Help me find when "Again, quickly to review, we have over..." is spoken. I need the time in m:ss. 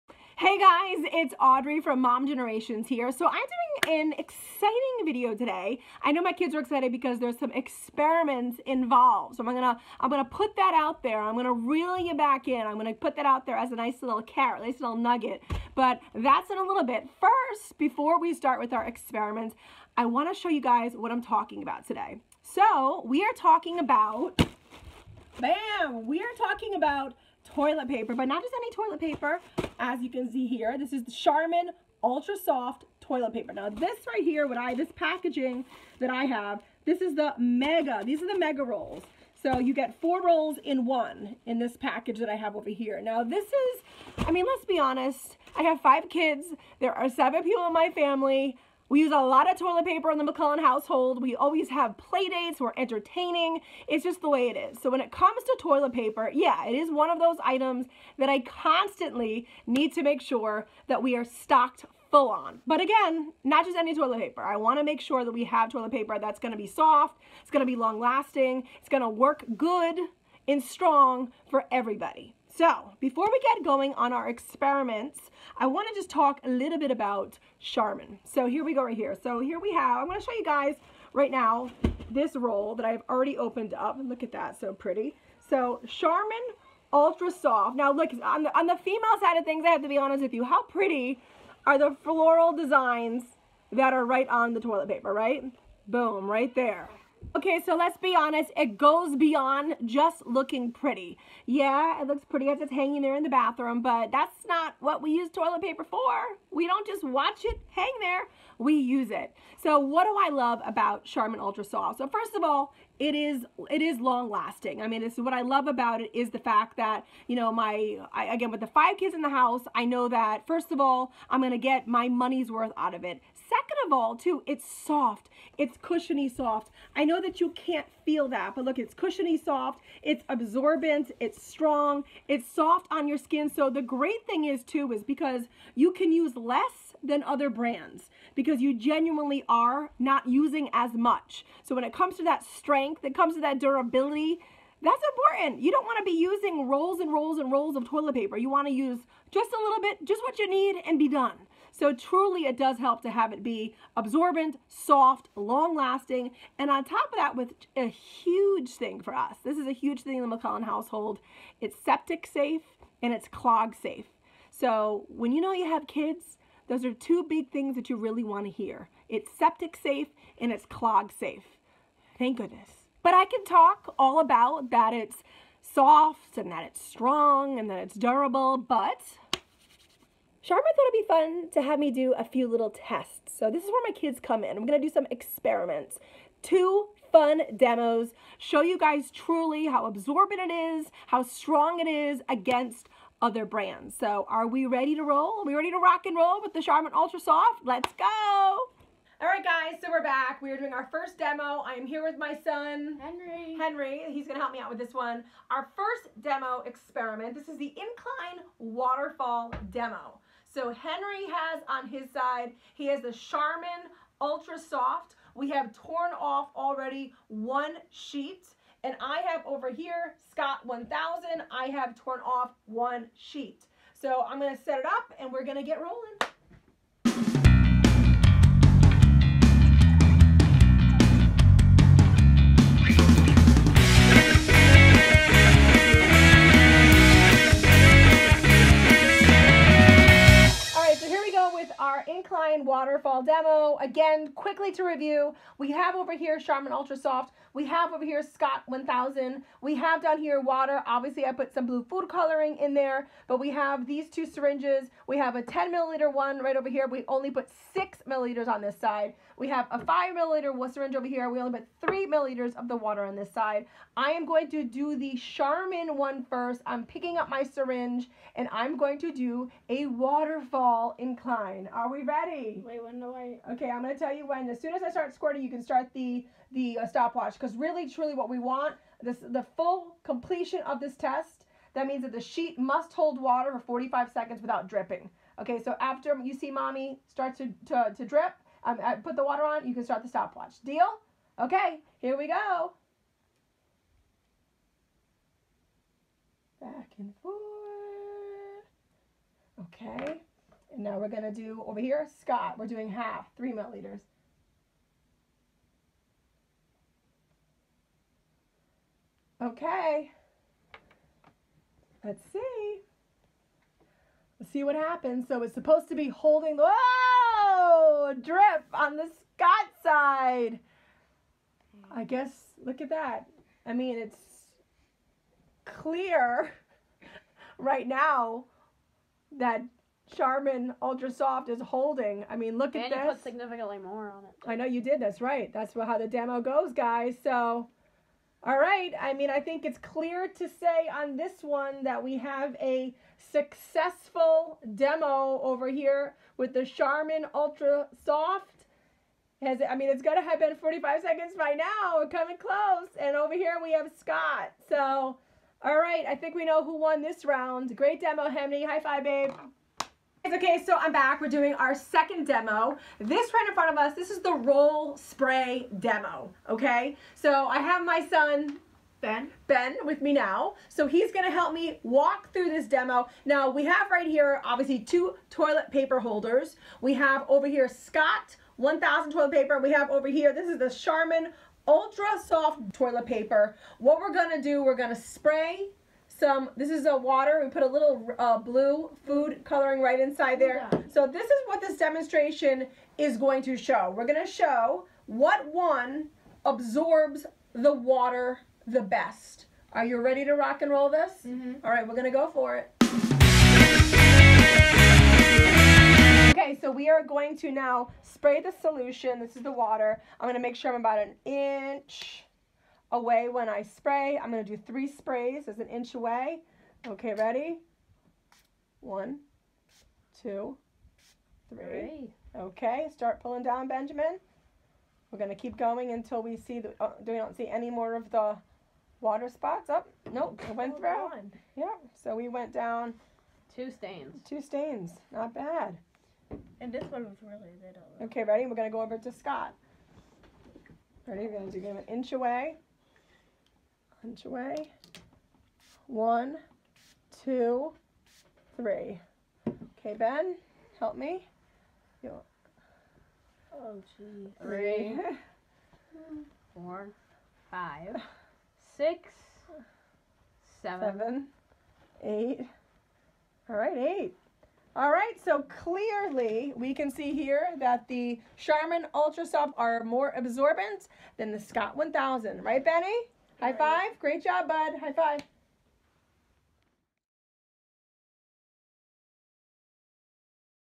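4:03.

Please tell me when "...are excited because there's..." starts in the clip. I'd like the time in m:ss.
0:06.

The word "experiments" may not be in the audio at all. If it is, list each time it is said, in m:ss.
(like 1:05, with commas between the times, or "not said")
0:07, 0:18, 1:14, 3:05, 3:26.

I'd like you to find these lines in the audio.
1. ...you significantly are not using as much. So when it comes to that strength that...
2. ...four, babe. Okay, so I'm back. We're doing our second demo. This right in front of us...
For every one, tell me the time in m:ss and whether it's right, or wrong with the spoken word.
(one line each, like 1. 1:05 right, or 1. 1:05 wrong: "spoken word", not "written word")
1. 2:18 wrong: "genuinely", not "significantly"
2. 5:58 wrong: "five", not "four".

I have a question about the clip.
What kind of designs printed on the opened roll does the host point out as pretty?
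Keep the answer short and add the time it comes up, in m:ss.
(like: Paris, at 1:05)
Floral designs, at 1:32.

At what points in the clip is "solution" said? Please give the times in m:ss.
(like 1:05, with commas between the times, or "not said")
6:48.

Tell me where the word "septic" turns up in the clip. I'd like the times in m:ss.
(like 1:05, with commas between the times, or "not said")
2:41, 2:49.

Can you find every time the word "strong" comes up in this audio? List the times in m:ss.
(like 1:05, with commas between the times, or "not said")
1:10, 2:11, 2:56, 3:11.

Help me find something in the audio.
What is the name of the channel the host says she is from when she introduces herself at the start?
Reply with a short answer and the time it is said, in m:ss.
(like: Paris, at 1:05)
Mom Generations, at 0:02.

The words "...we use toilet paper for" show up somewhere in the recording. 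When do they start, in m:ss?
1:45.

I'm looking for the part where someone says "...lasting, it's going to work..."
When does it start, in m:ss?
1:07.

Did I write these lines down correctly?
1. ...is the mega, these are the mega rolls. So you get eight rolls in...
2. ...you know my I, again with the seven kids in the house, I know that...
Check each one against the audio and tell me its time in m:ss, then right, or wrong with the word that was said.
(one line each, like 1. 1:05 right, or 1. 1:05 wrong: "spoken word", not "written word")
1. 0:37 wrong: "four", not "eight"
2. 1:57 wrong: "five", not "seven".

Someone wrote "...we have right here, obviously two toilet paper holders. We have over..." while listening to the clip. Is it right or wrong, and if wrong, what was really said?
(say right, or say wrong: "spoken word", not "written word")
right.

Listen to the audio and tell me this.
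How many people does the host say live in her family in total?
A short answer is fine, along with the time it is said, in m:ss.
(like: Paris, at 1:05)
7, at 0:47.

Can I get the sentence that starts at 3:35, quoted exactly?
We have torn off already one sheet.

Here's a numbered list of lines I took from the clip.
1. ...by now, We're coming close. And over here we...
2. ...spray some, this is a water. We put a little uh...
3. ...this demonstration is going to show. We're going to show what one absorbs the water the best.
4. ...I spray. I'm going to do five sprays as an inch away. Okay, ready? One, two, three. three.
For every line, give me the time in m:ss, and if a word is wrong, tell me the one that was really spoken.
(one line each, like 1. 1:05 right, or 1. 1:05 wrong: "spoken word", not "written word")
1. 5:51 right
2. 6:24 right
3. 6:31 right
4. 6:53 wrong: "three", not "five".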